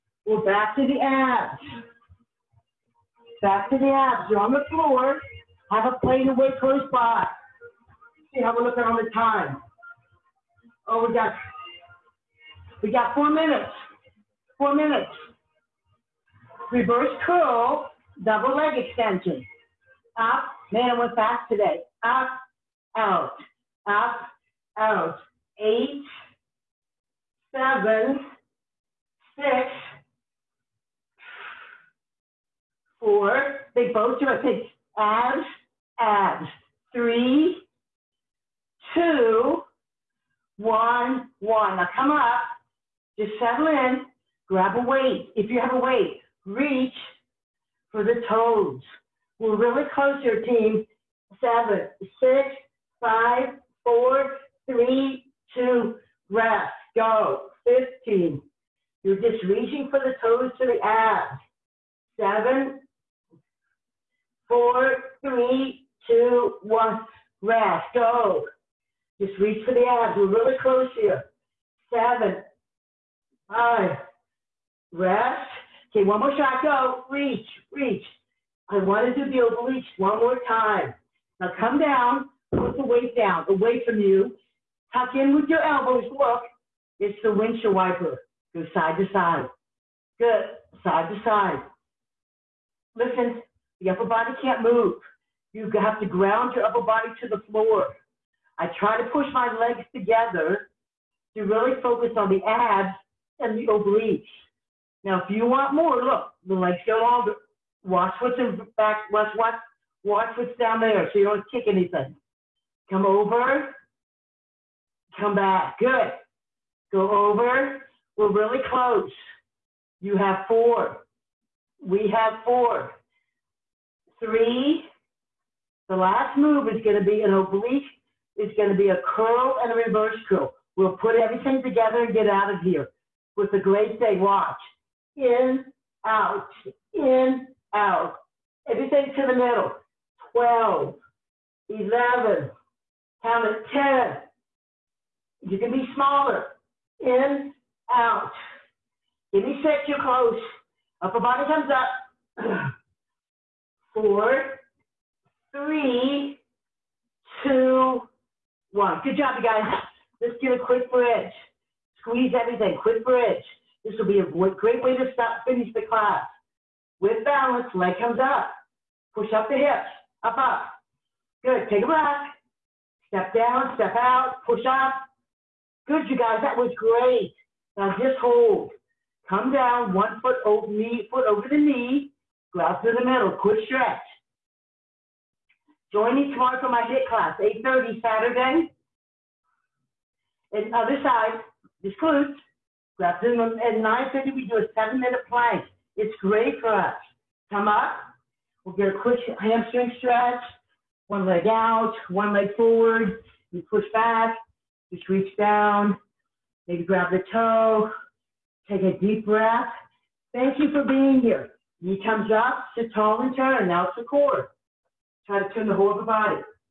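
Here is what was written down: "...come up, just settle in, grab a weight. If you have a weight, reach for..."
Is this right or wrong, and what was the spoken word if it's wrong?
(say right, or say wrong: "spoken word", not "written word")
right.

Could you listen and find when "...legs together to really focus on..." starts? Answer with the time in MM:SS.
01:39.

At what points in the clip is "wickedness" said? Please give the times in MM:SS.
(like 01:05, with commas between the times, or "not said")
not said.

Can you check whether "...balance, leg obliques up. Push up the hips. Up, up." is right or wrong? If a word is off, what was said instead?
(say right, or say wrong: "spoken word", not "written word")
wrong: "comes", not "obliques".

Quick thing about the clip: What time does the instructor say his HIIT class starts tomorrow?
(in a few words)
8:30.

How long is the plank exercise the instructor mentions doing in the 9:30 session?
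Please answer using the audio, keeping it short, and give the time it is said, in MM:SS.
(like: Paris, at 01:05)
7 minutes, at 03:14.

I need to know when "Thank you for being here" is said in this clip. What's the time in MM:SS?
03:30.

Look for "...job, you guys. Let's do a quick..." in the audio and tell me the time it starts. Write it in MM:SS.
02:39.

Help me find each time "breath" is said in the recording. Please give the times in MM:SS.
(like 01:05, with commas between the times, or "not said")
02:51, 03:29.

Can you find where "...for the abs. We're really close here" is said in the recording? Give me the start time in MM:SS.
01:09.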